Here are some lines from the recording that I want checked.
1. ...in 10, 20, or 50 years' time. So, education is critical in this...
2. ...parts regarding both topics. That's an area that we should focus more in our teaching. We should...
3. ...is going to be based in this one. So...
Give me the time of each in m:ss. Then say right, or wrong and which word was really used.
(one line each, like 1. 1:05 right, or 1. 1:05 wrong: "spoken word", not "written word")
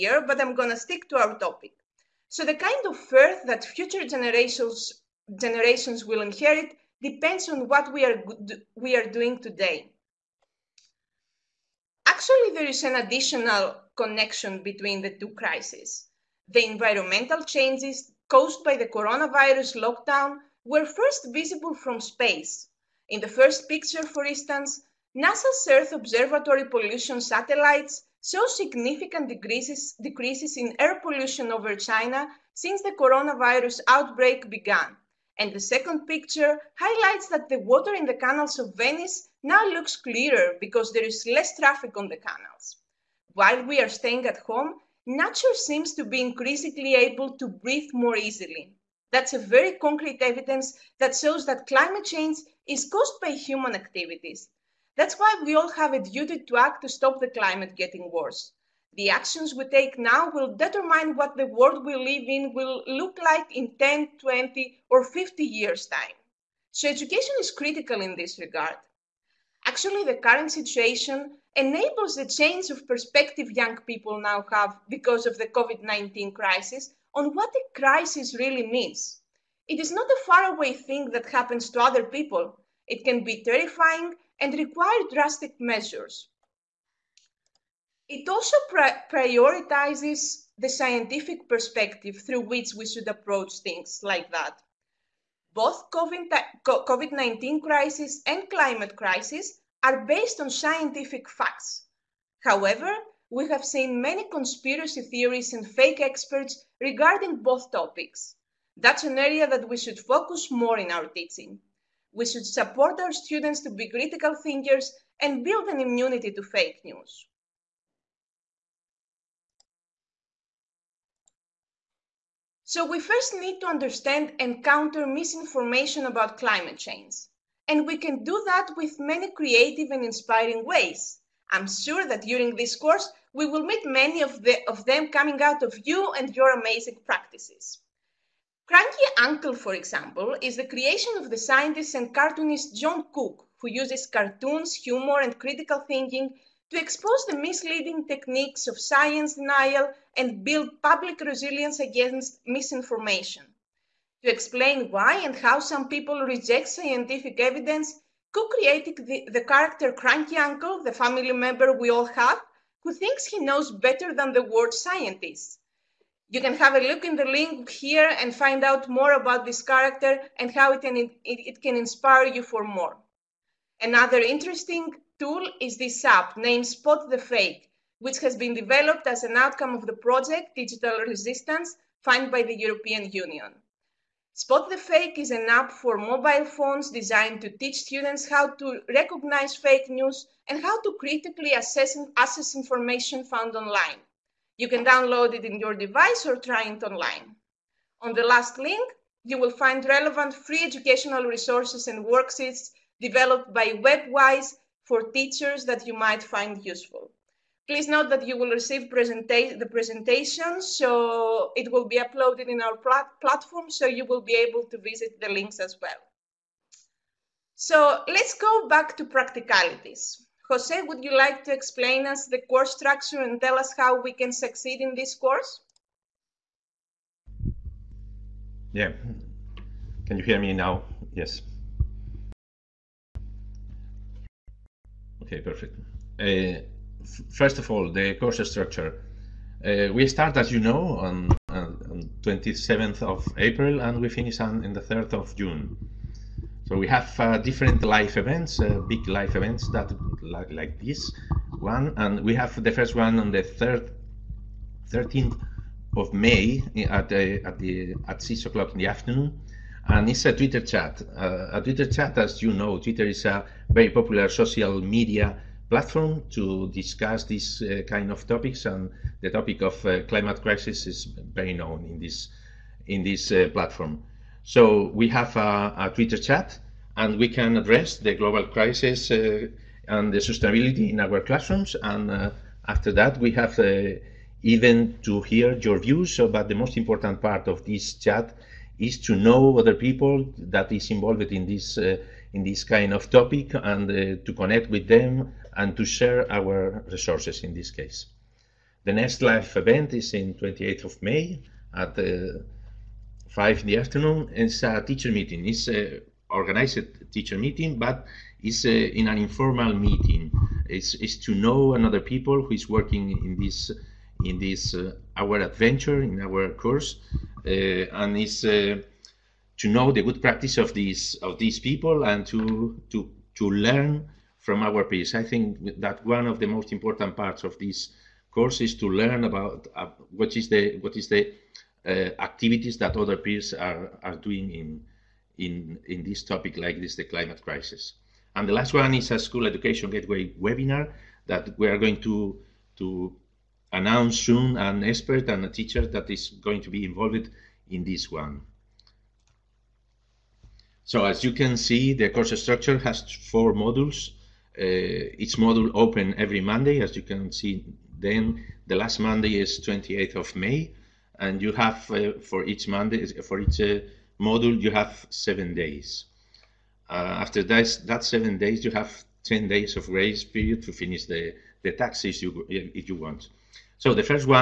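1. 1:03 right
2. 1:45 wrong: "experts", not "parts"
3. 5:46 wrong: "involved", not "based".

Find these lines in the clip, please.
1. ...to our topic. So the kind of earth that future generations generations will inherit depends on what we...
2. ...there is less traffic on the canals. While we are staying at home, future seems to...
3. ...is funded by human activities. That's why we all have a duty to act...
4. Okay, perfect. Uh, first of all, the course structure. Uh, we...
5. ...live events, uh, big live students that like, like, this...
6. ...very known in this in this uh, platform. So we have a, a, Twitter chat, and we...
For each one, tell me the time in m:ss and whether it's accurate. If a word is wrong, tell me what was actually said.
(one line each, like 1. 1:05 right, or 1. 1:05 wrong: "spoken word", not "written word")
1. 0:01 right
2. 0:40 wrong: "nature", not "future"
3. 0:52 wrong: "caused", not "funded"
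4. 3:55 right
5. 4:07 wrong: "events", not "students"
6. 4:31 right.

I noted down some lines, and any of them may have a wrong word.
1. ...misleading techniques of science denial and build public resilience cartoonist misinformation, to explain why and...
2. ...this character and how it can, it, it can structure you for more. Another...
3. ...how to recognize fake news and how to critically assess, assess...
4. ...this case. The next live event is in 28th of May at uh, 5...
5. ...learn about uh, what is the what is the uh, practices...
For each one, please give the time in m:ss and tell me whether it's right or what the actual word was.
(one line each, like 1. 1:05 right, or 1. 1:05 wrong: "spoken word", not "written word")
1. 2:27 wrong: "against", not "cartoonist"
2. 2:49 wrong: "inspire", not "structure"
3. 3:08 right
4. 4:57 right
5. 5:28 wrong: "activities", not "practices".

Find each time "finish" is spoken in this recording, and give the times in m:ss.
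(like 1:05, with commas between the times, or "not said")
4:04, 6:10.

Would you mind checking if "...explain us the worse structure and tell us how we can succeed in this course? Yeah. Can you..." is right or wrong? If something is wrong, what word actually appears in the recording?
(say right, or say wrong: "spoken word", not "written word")
wrong: "course", not "worse".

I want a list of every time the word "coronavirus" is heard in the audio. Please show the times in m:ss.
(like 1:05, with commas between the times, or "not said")
0:18, 0:32.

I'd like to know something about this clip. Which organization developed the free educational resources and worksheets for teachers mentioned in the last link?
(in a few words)
WebWise.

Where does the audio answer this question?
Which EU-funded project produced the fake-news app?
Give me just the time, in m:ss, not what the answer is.
3:00.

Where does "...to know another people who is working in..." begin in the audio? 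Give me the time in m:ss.
5:11.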